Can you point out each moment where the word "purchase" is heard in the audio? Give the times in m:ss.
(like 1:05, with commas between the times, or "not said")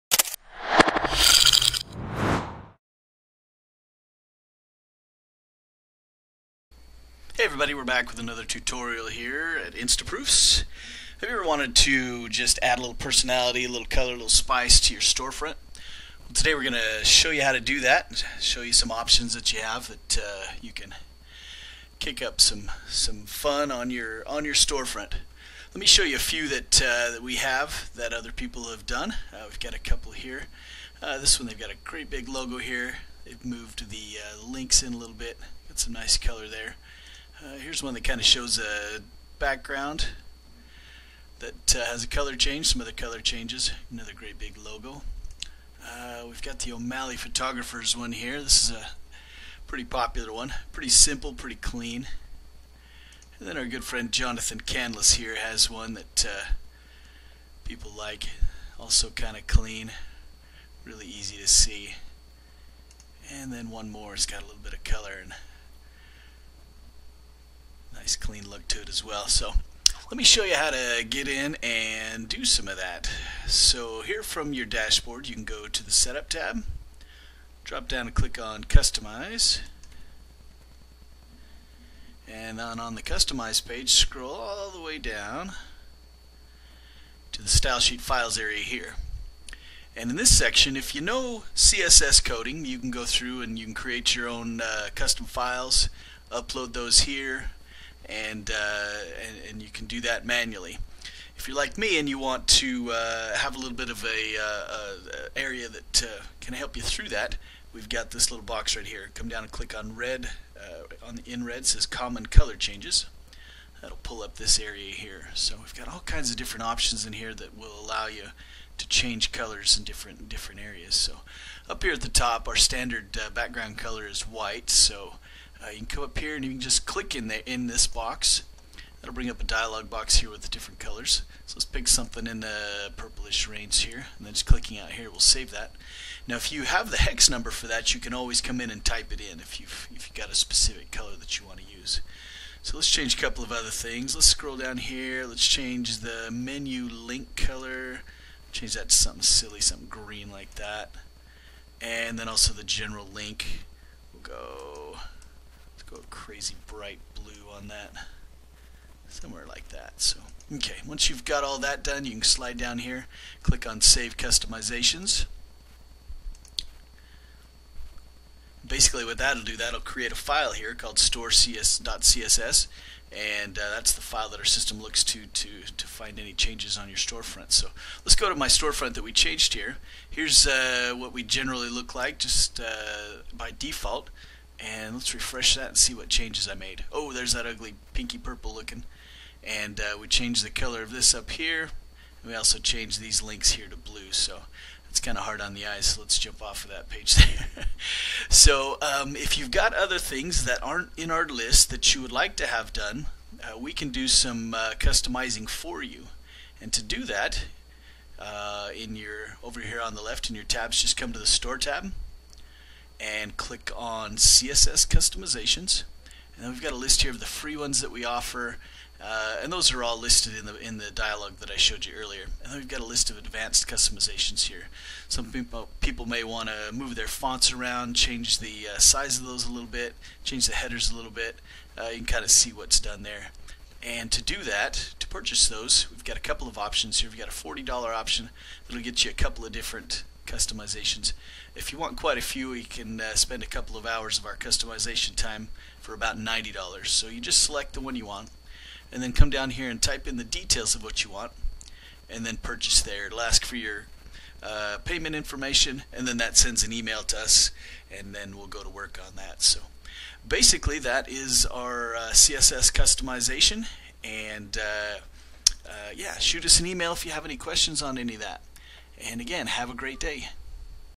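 3:55, 4:12.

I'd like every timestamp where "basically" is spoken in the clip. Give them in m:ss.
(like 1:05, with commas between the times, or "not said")
2:48, 4:20.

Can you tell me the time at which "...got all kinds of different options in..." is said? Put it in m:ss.
1:55.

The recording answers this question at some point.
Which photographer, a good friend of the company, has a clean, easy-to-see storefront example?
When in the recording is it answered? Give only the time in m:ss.
0:54.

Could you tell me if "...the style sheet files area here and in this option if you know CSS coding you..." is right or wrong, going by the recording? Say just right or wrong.
wrong.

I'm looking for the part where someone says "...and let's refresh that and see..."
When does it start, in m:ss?
3:04.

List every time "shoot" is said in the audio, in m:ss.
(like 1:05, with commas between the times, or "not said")
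4:26.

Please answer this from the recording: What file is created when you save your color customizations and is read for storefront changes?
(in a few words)
store.css.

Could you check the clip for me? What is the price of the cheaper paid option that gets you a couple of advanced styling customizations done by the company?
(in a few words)
$40.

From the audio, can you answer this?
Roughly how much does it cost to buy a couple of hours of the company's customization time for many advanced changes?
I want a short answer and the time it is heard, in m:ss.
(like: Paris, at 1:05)
$90, at 4:06.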